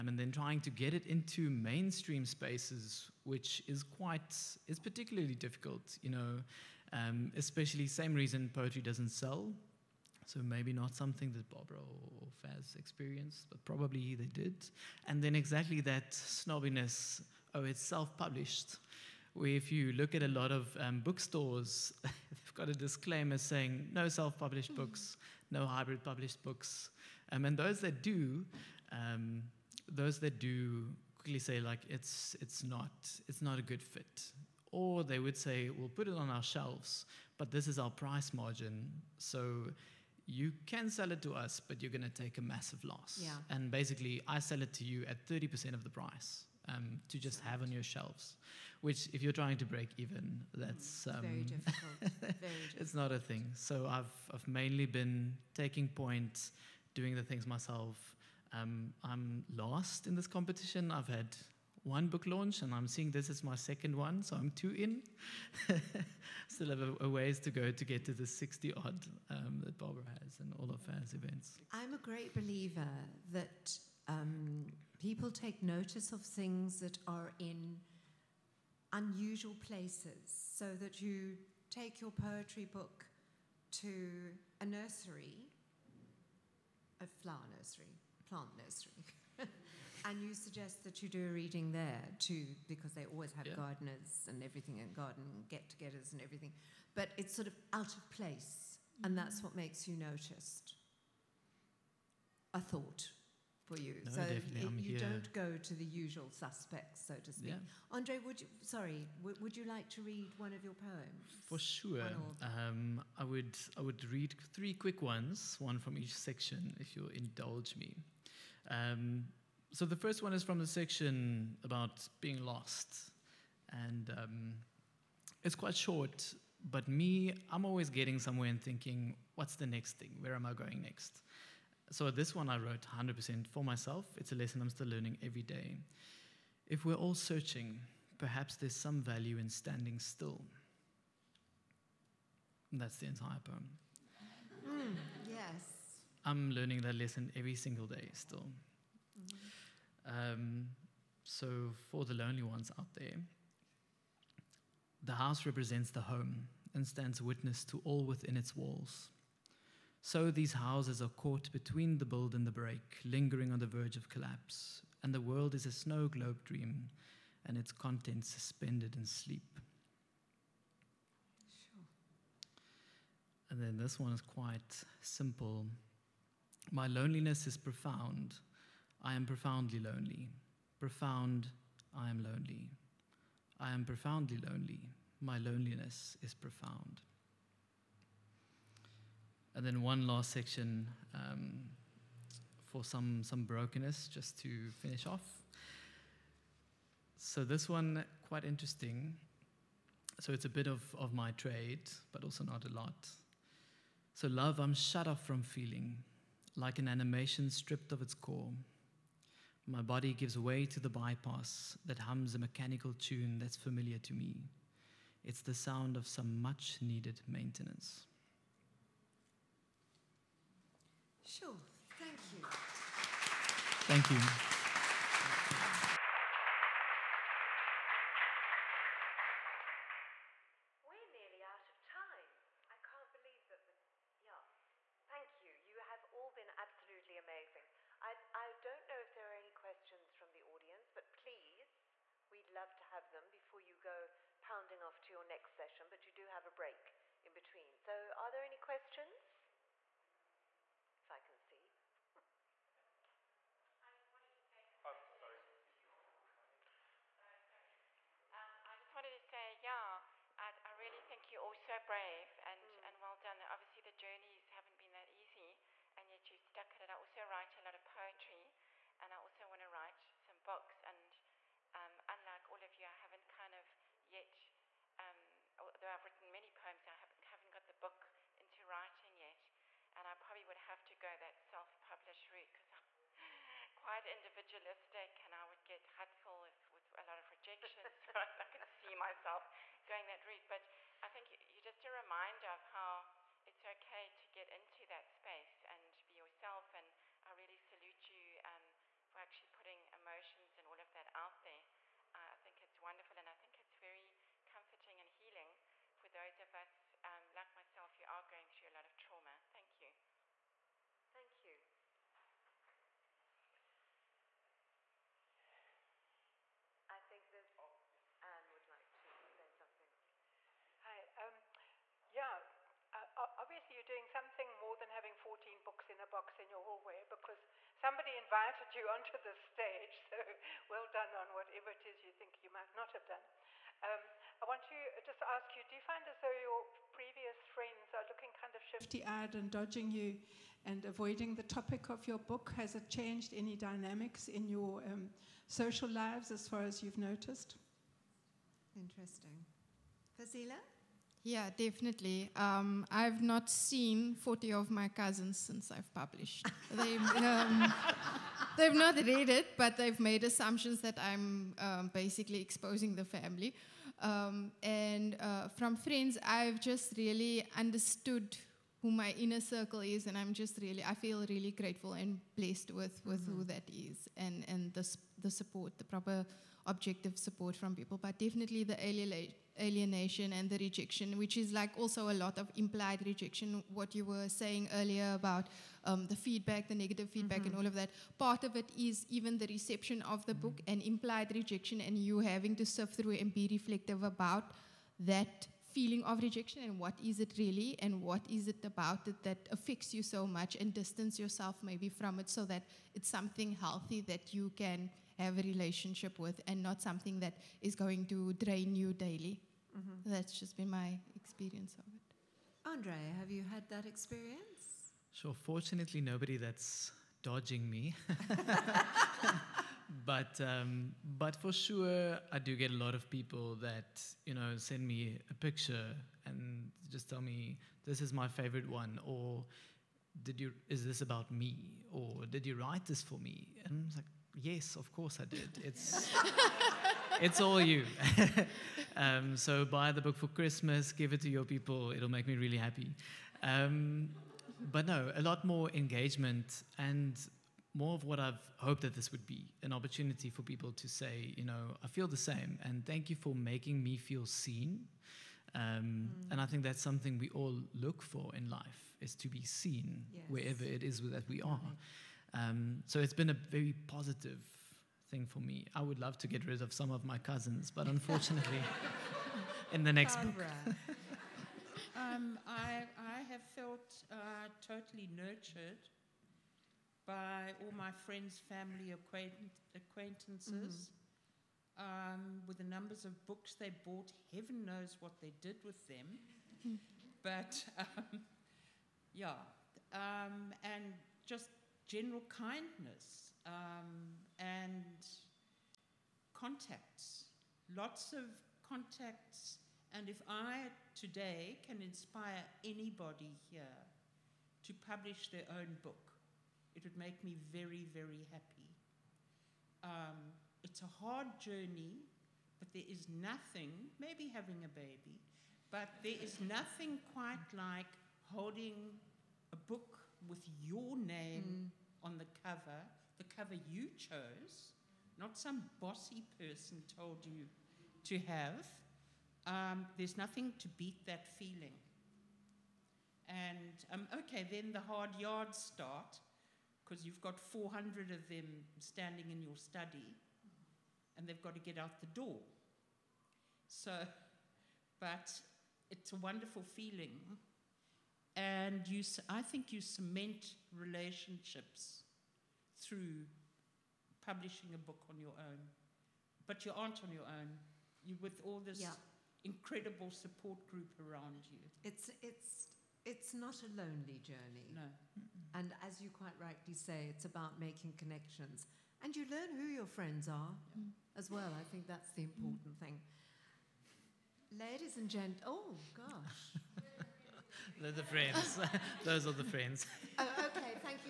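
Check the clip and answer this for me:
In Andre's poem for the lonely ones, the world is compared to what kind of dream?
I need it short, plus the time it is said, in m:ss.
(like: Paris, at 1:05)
Snow globe dream, at 2:45.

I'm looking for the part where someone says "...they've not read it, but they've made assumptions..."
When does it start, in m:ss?
5:58.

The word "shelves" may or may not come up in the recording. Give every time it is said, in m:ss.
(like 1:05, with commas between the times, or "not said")
0:36, 0:47.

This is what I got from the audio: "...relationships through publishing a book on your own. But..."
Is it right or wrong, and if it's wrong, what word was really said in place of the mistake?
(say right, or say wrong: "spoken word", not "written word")
right.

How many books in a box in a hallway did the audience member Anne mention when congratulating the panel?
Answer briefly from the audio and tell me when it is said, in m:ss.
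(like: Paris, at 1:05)
14, at 5:25.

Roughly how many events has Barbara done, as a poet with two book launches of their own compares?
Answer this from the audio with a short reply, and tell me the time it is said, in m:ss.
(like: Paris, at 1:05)
60, at 1:08.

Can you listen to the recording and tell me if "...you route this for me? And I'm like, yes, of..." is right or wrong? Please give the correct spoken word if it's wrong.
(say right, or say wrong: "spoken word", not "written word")
wrong: "write", not "route".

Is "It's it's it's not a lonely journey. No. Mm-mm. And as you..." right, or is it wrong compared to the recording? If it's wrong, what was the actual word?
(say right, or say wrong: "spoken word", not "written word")
right.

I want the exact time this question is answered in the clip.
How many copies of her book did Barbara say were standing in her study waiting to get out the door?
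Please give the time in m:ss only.
8:57.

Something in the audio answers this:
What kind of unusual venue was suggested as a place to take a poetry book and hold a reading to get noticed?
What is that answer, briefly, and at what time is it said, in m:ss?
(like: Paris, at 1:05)
Plant nursery, at 1:28.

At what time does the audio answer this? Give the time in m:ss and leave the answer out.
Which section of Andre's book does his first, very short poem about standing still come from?
2:02.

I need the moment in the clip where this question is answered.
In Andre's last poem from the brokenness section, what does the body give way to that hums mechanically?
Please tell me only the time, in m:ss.
3:30.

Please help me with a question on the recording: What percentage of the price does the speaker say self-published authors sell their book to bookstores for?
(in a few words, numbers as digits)
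30%.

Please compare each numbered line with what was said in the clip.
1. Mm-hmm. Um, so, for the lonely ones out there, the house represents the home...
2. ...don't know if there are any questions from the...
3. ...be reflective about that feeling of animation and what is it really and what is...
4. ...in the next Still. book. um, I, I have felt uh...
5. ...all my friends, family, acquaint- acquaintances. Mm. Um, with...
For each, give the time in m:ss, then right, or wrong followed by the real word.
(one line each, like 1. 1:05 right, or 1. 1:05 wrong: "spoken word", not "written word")
1. 2:29 right
2. 3:58 right
3. 6:33 wrong: "rejection", not "animation"
4. 7:49 wrong: "Barbara", not "Still"
5. 7:57 right.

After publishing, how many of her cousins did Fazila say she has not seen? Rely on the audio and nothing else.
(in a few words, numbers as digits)
40.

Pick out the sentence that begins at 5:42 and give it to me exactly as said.
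Has it changed any dynamics in your um, social lives as far as you've noticed?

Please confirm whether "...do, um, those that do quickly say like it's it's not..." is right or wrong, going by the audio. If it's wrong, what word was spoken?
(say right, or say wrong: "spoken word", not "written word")
right.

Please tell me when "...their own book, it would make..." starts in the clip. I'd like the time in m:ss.
8:25.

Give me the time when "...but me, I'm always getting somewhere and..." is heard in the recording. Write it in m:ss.
2:06.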